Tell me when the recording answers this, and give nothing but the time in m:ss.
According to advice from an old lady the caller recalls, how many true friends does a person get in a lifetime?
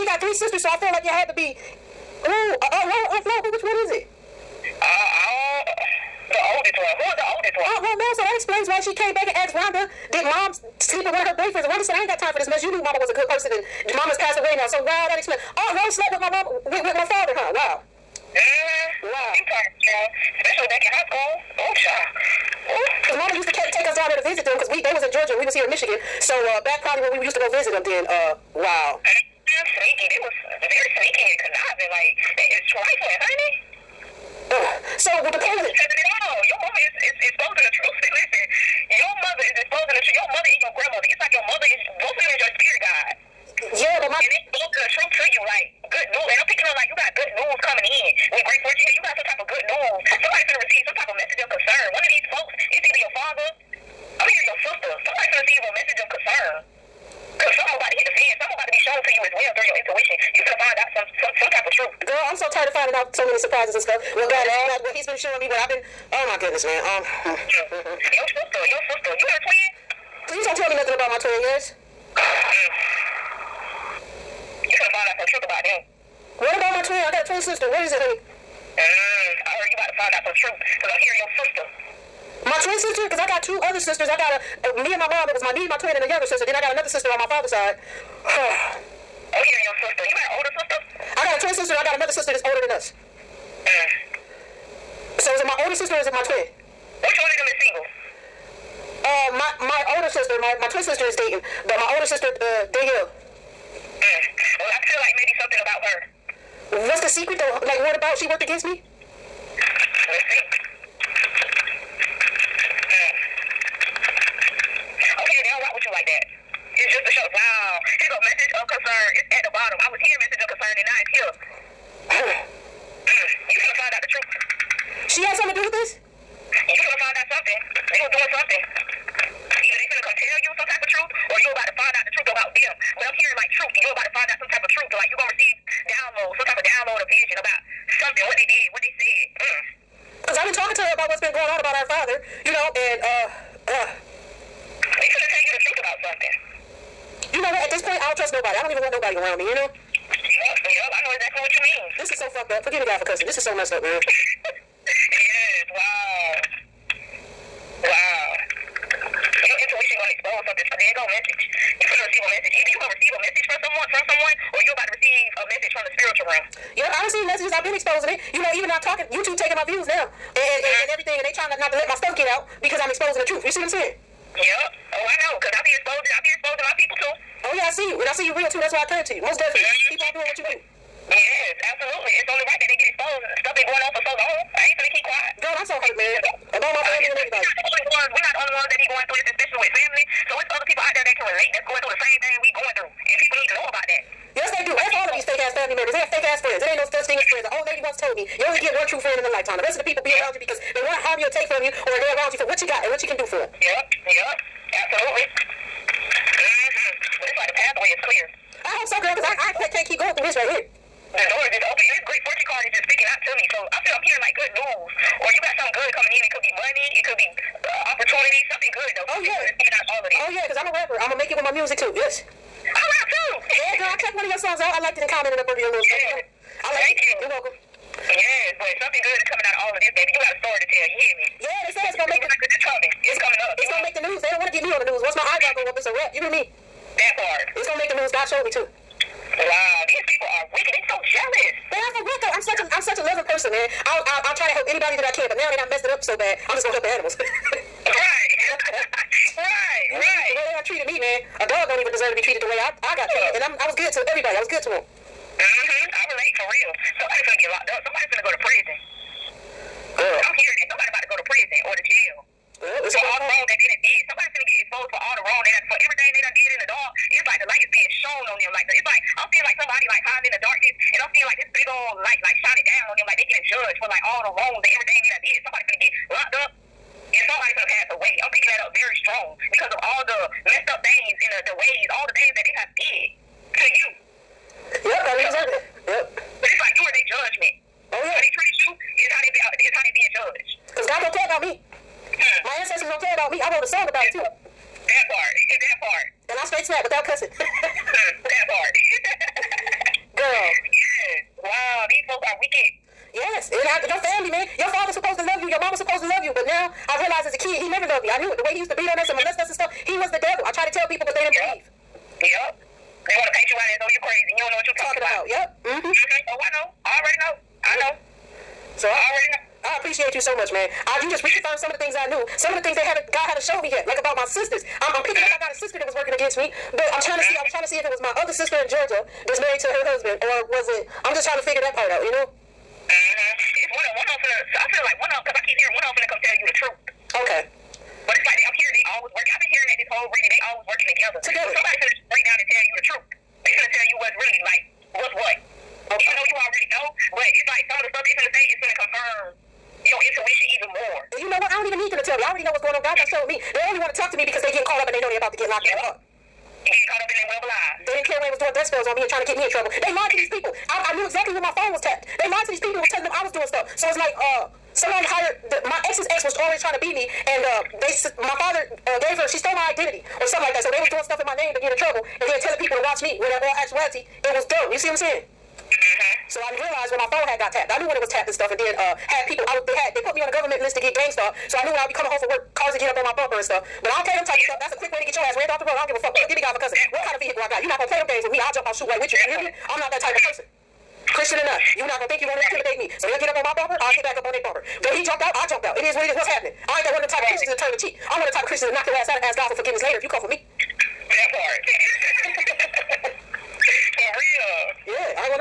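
3:18.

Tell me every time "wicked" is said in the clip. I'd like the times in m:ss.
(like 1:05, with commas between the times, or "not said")
4:00, 5:02.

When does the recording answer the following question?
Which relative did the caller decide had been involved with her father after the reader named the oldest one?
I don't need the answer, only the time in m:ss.
0:15.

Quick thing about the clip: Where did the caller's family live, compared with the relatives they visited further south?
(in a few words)
Michigan.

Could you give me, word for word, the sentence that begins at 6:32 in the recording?
So they'll get up on my bumper, I'll get back up on their bumper.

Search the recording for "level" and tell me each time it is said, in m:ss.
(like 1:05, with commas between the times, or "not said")
not said.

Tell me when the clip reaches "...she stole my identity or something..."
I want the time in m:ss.
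6:09.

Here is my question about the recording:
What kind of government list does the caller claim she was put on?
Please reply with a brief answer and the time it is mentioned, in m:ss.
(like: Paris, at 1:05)
gang, at 6:20.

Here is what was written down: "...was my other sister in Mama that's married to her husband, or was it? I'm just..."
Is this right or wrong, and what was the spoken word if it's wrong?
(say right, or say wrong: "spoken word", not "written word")
wrong: "Georgia", not "Mama".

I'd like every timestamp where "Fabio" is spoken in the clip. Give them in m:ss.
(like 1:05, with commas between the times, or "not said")
not said.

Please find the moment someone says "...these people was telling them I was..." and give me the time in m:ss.
6:02.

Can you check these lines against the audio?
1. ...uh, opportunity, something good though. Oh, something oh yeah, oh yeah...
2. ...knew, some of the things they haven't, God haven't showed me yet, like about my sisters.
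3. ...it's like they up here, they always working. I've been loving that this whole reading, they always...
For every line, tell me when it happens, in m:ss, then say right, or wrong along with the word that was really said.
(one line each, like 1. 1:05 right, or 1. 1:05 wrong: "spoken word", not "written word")
1. 3:37 right
2. 5:22 right
3. 5:38 wrong: "hearing", not "loving".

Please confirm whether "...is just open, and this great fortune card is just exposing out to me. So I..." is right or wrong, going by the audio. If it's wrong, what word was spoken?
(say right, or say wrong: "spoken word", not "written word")
wrong: "speaking", not "exposing".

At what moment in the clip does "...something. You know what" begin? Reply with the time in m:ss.
2:26.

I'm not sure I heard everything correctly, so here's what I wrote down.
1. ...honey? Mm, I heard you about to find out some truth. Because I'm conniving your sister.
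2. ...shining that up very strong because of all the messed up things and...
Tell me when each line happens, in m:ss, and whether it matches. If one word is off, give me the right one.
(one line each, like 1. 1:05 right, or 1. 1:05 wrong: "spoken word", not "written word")
1. 1:17 wrong: "hearing", not "conniving"
2. 4:38 wrong: "picking", not "shining".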